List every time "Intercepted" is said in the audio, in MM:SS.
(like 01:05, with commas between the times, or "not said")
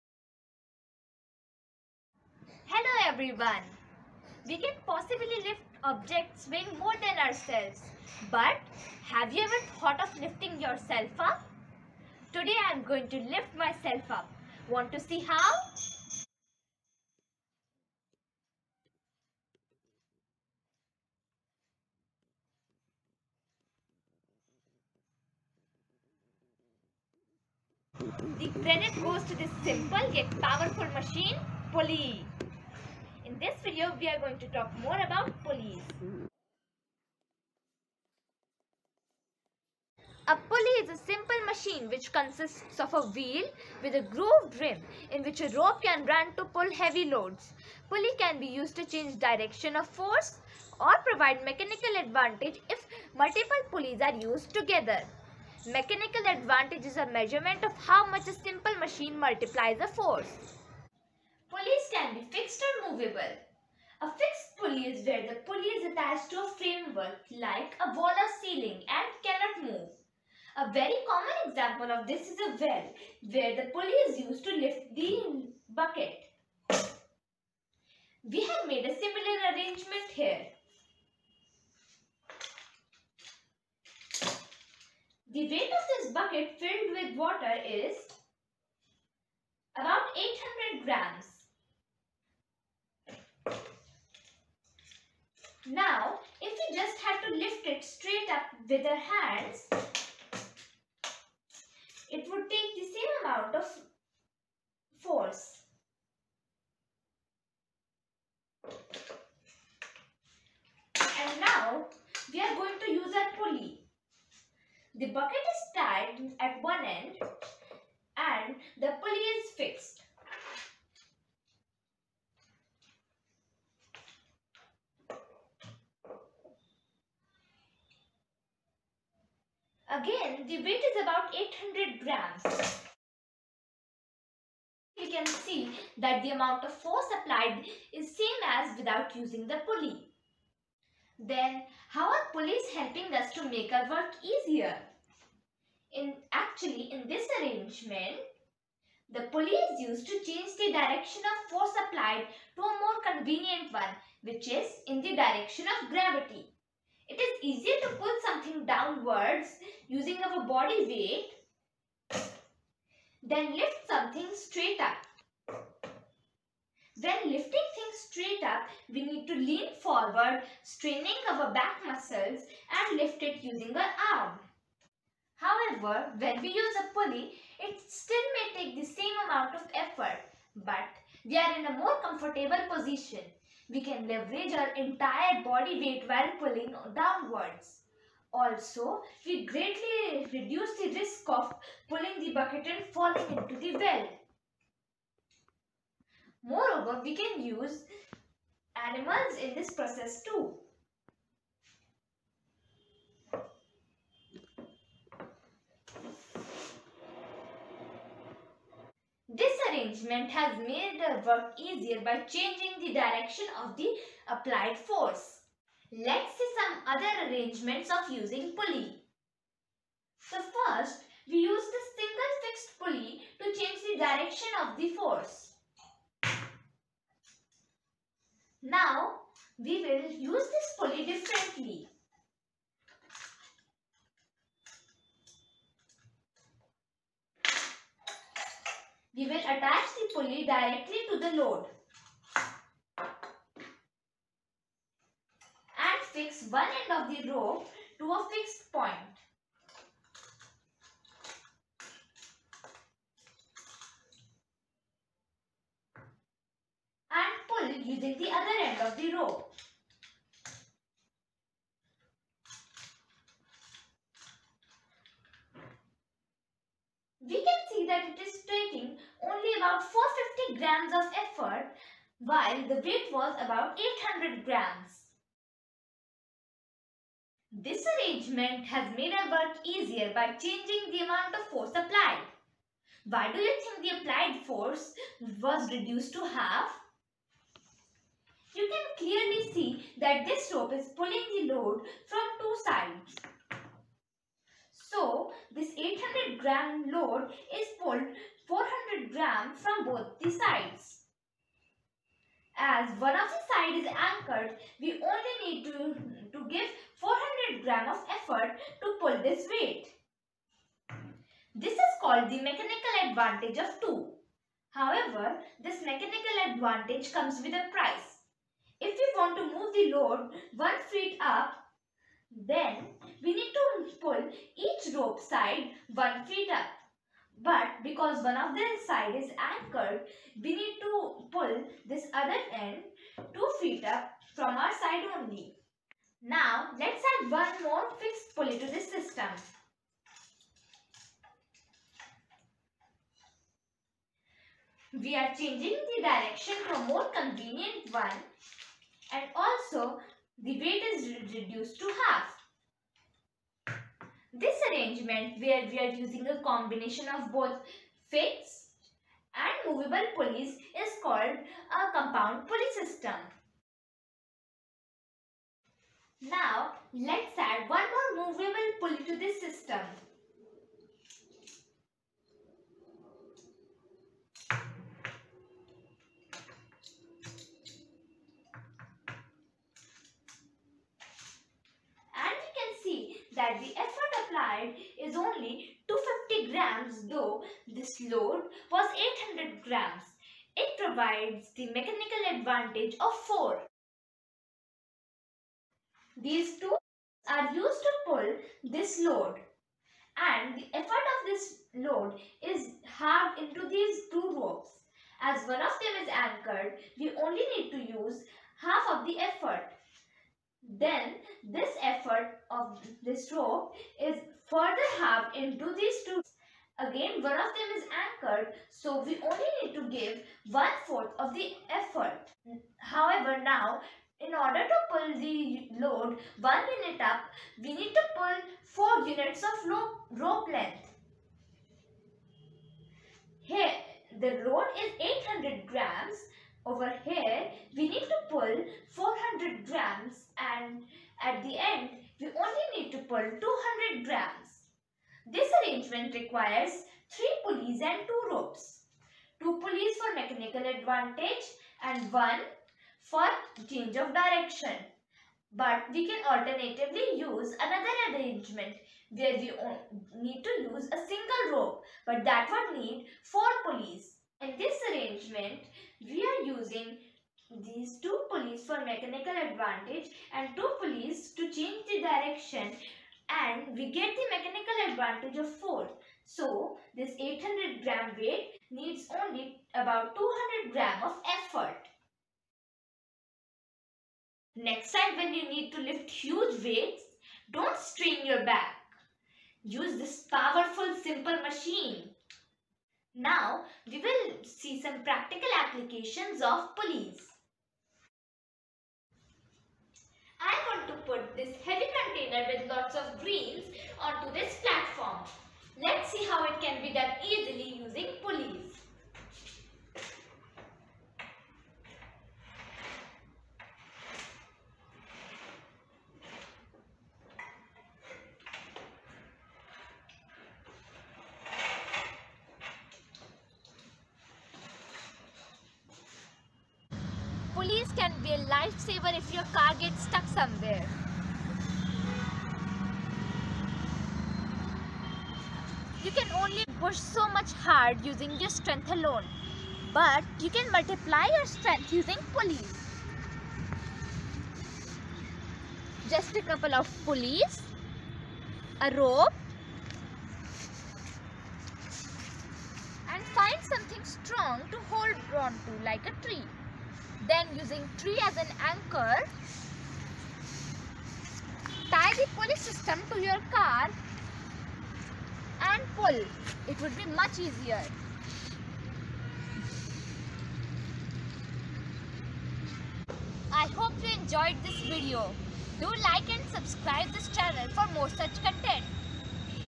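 not said.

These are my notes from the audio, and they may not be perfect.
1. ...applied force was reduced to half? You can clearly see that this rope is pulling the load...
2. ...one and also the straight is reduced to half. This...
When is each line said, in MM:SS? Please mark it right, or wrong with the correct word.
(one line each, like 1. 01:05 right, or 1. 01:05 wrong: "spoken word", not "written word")
1. 04:43 right
2. 05:47 wrong: "weight", not "straight".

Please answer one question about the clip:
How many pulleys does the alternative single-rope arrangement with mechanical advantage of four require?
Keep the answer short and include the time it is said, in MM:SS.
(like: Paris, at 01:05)
4, at 07:43.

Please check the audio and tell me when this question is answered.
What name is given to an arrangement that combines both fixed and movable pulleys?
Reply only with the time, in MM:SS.
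06:01.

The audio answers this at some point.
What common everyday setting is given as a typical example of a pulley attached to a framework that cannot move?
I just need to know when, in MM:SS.
01:12.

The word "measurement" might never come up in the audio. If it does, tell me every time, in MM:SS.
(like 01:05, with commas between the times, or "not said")
00:57.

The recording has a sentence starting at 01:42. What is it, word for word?
It would take the same amount of force.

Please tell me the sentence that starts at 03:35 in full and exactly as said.
Let's see some other arrangements of using pulley.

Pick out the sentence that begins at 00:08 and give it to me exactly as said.
But have you ever thought of lifting yourself up?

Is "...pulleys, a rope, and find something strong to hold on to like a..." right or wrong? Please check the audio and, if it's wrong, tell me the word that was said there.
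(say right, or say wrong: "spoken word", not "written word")
right.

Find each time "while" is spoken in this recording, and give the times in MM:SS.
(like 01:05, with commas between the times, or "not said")
03:06, 04:32.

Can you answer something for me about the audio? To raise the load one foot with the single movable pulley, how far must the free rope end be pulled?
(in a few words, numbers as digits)
2 feet.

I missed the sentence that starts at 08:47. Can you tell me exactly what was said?
Pulleys can be a lifesaver if your car gets stuck somewhere.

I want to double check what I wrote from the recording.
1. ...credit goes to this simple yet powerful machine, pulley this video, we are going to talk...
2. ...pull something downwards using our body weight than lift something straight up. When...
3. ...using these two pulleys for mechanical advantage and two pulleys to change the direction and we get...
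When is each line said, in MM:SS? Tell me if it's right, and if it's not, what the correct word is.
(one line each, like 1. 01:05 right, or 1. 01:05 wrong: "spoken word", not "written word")
1. 00:28 right
2. 02:37 right
3. 07:46 right.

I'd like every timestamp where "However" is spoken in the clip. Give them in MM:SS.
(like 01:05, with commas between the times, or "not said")
02:55, 05:14, 07:02.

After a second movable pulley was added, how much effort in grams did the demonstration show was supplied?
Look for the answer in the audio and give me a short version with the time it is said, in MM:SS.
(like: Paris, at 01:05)
250 grams, at 06:25.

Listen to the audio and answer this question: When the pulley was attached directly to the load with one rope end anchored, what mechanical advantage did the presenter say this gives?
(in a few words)
2.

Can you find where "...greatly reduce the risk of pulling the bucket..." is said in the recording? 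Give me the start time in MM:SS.
03:09.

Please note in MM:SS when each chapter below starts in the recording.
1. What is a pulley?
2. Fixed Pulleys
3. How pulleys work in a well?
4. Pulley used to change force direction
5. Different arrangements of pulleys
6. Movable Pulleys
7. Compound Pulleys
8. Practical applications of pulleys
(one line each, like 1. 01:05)
1. 00:40
2. 01:03
3. 01:24
4. 02:26
5. 03:36
6. 03:49
7. 05:36
8. 08:18.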